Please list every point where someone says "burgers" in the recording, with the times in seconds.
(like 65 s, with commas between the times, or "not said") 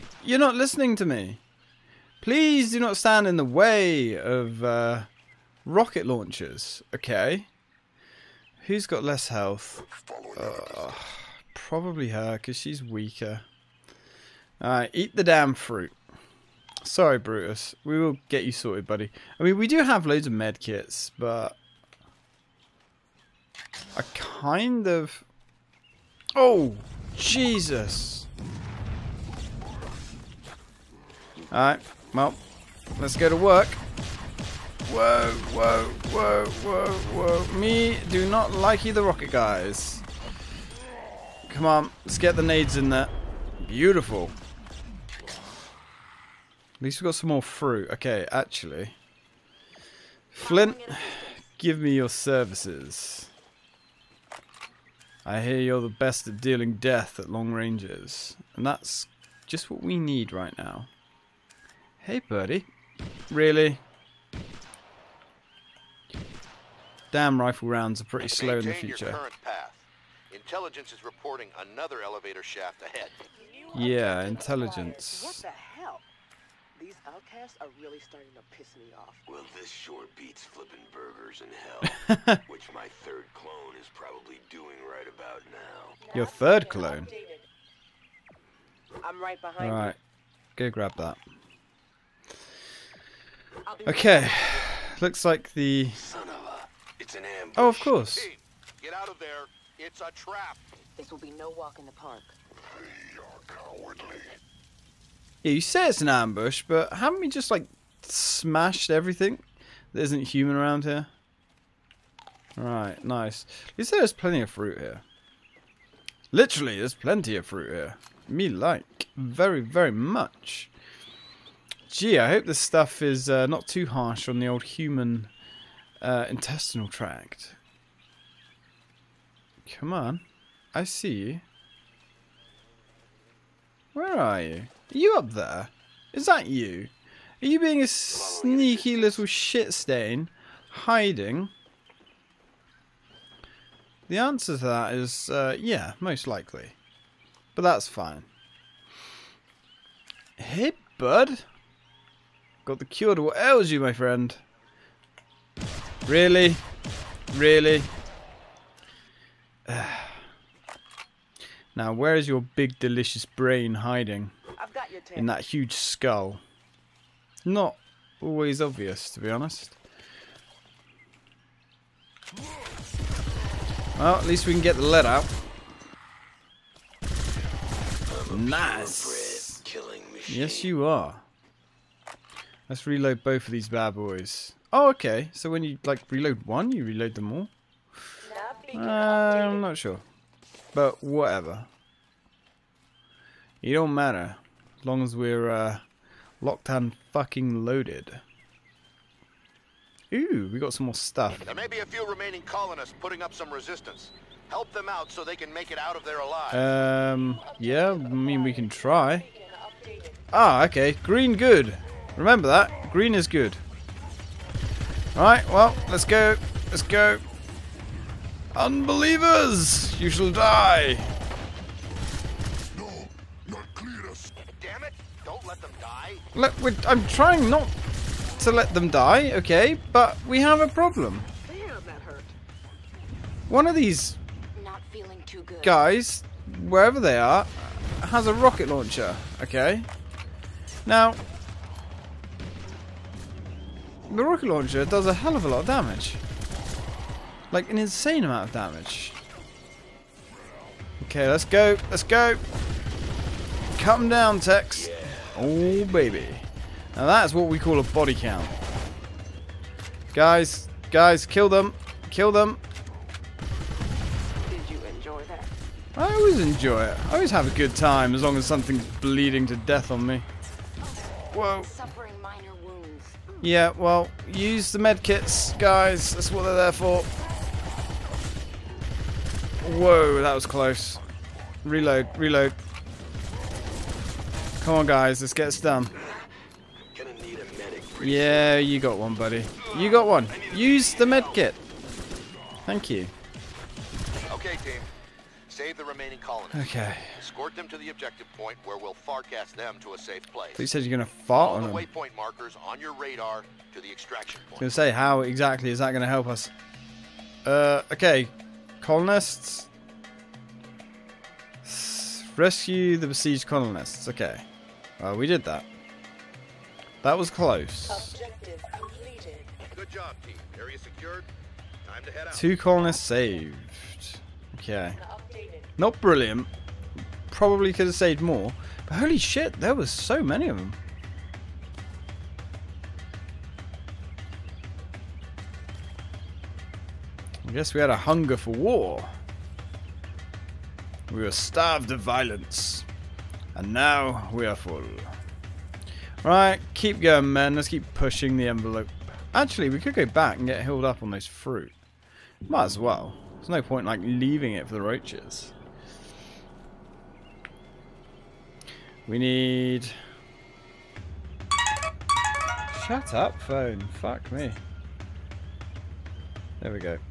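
80 s.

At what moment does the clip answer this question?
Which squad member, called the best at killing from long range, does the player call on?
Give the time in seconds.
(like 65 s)
50 s.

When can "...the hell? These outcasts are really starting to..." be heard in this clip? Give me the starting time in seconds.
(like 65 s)
75 s.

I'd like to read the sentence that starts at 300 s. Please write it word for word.
He said you're going to fall All on the them.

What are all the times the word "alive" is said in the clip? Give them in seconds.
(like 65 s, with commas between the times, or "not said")
206 s.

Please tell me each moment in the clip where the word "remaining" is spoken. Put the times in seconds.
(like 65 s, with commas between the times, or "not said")
202 s, 295 s.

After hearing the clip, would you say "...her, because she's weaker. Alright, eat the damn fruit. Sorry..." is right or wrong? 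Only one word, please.
right.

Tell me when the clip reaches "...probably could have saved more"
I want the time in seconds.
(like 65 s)
327 s.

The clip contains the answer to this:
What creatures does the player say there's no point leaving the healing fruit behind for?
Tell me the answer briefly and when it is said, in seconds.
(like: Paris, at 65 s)
roaches, at 354 s.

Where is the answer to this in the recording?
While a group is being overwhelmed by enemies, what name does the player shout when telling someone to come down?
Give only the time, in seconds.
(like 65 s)
254 s.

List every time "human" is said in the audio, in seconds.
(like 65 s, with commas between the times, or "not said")
110 s, 124 s.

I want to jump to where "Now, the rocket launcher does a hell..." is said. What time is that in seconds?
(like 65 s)
240 s.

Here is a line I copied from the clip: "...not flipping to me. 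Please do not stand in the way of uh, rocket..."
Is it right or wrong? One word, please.
wrong.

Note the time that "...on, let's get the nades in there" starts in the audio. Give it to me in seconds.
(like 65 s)
41 s.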